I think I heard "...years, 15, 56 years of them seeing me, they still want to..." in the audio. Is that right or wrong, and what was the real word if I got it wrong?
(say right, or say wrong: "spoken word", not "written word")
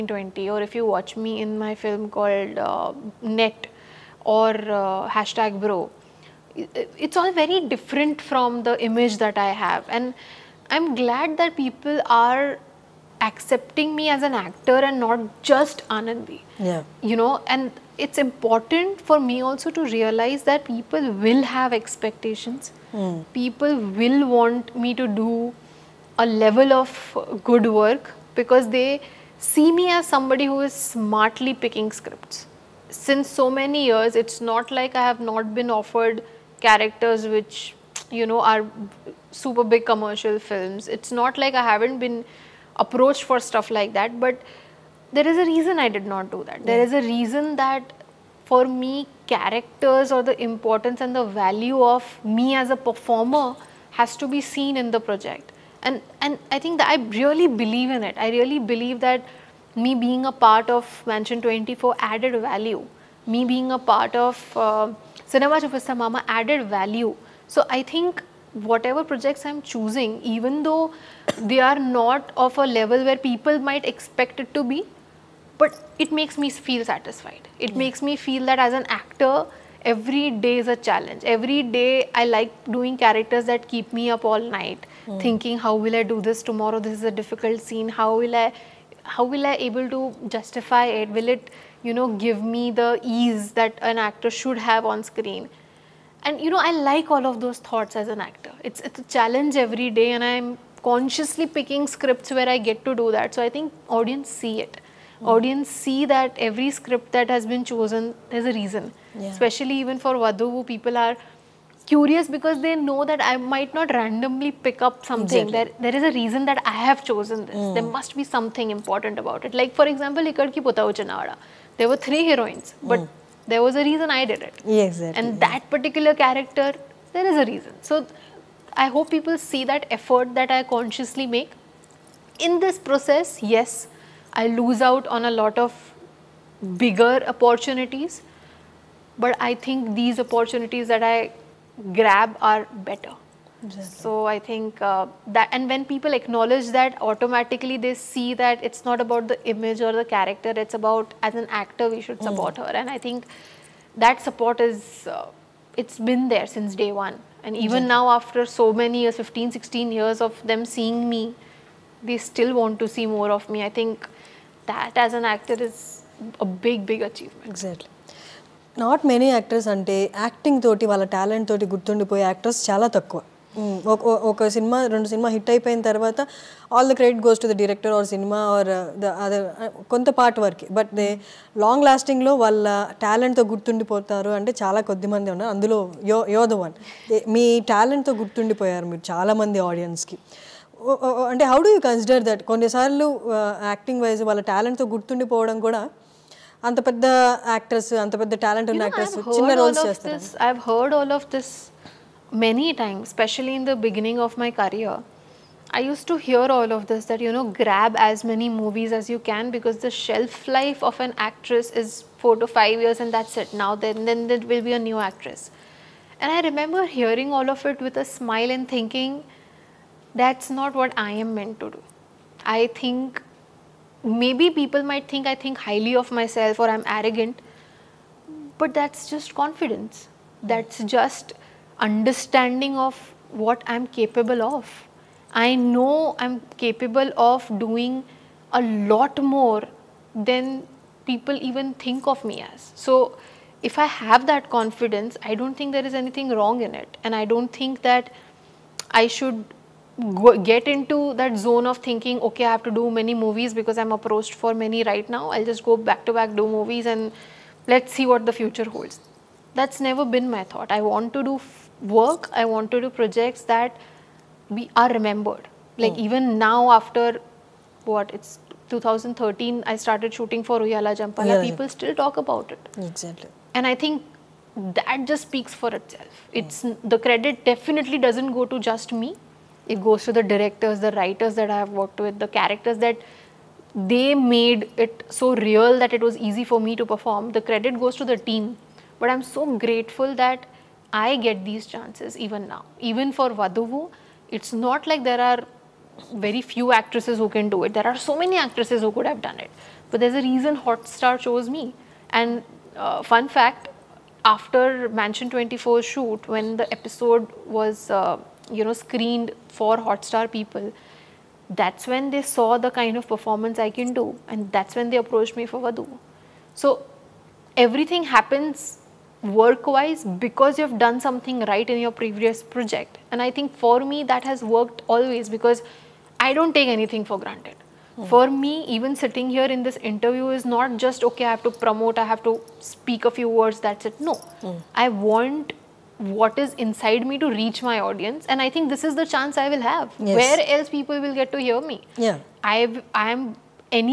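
wrong: "16", not "56".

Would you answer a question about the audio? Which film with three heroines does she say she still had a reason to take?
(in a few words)
Ekkadiki.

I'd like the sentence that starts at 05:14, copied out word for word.
And that's when they approached me for Vadhu.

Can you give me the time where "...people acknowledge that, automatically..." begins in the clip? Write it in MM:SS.
02:25.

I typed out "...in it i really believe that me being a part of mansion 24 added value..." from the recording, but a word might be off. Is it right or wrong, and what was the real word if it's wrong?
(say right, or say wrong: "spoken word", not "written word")
right.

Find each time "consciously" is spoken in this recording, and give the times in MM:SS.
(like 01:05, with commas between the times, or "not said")
01:40, 02:10.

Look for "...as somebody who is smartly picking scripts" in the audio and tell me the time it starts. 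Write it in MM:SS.
00:29.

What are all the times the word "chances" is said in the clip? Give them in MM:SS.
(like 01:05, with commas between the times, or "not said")
04:51, 05:39.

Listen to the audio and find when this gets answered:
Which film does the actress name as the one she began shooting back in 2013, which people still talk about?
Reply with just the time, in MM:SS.
04:30.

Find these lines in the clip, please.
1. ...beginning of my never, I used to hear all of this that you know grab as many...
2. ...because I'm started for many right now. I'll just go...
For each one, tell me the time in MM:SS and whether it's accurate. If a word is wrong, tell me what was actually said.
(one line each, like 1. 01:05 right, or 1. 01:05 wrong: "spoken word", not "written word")
1. 03:23 wrong: "career", not "never"
2. 04:13 wrong: "approached", not "started".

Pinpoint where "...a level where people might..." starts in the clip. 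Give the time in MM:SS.
01:12.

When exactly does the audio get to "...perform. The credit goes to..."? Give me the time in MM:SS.
04:46.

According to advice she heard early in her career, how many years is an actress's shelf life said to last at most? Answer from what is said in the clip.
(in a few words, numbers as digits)
5.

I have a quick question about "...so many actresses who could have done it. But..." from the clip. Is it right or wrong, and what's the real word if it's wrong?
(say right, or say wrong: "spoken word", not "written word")
right.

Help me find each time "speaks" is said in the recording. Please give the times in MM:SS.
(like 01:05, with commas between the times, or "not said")
04:35, 05:32.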